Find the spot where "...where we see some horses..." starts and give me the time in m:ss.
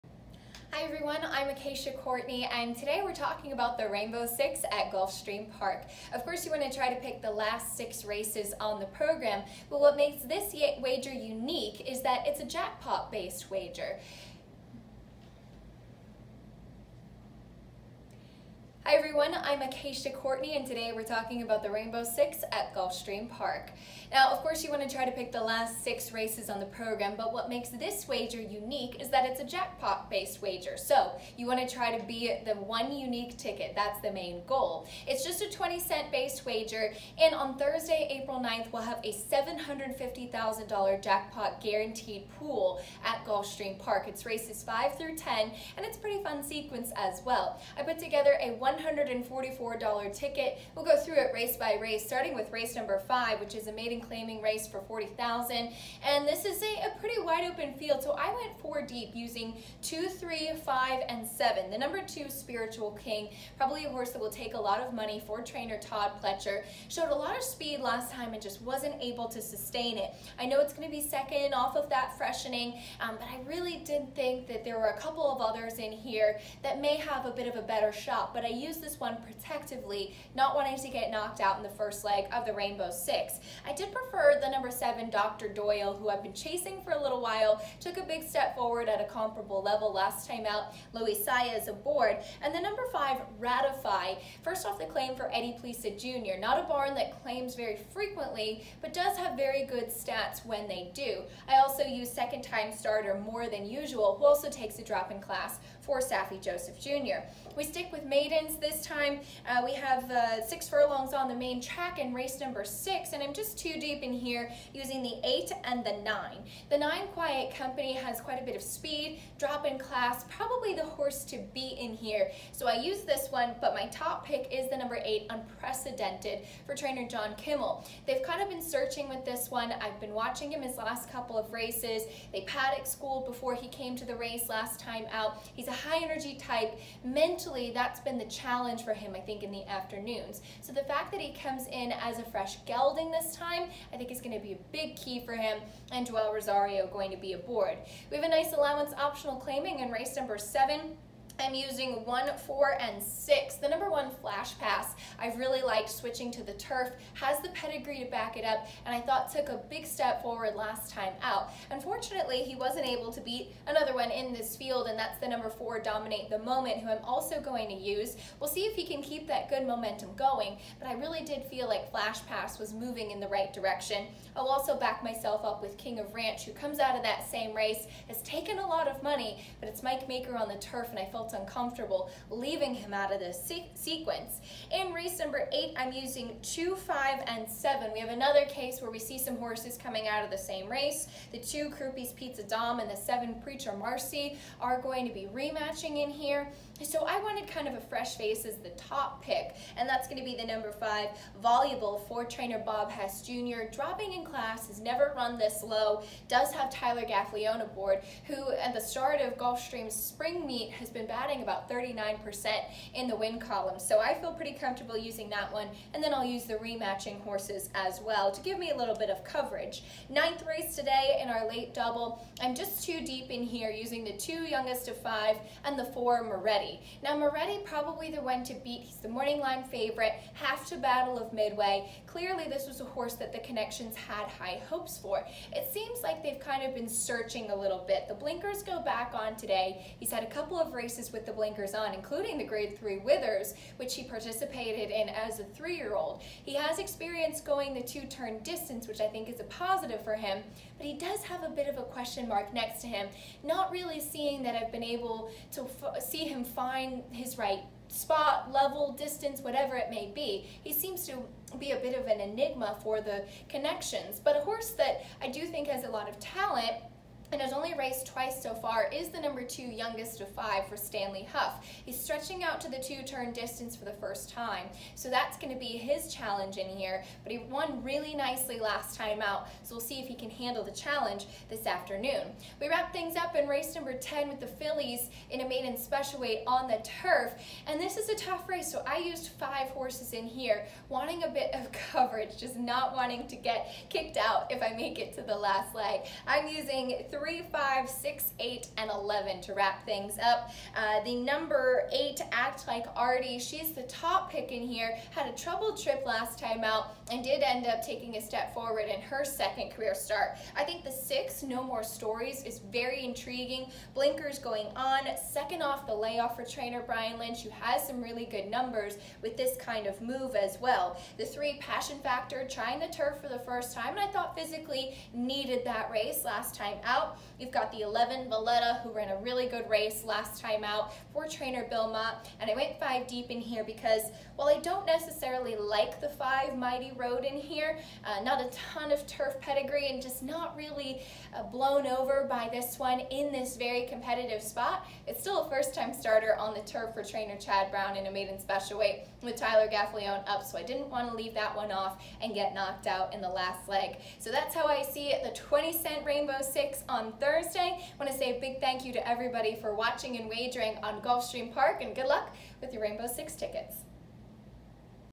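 3:08.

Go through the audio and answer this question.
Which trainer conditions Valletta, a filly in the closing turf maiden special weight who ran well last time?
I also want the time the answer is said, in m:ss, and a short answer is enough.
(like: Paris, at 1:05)
Bill Mott, at 5:31.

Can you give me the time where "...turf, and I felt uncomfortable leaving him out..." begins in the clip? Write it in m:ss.
3:00.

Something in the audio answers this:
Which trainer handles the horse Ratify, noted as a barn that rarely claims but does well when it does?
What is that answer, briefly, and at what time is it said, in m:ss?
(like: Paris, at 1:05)
Eddie Plesa Jr., at 1:35.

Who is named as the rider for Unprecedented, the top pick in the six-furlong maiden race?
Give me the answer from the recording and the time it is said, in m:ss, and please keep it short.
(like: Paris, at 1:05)
Joel Rosario, at 2:26.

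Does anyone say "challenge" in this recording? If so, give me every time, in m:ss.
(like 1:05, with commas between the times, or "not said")
2:18, 4:36, 4:40.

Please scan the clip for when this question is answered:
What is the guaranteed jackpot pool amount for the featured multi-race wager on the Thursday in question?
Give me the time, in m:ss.
0:39.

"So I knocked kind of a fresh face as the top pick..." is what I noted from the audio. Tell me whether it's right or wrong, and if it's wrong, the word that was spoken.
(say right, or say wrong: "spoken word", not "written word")
wrong: "wanted", not "knocked".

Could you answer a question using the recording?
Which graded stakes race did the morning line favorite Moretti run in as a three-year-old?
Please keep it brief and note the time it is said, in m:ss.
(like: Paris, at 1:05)
Withers, at 4:02.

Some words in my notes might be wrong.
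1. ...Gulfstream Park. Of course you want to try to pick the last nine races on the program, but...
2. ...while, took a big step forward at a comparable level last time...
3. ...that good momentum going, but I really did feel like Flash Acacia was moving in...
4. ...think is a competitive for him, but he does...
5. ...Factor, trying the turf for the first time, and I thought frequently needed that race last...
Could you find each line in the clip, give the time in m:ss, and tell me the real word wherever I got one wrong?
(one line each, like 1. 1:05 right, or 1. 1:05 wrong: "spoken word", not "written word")
1. 0:04 wrong: "six", not "nine"
2. 1:27 right
3. 2:49 wrong: "Pass", not "Acacia"
4. 4:09 wrong: "positive", not "competitive"
5. 5:21 wrong: "physically", not "frequently".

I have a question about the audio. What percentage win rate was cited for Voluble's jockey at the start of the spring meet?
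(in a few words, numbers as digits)
39%.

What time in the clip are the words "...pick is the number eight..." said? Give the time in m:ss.
2:04.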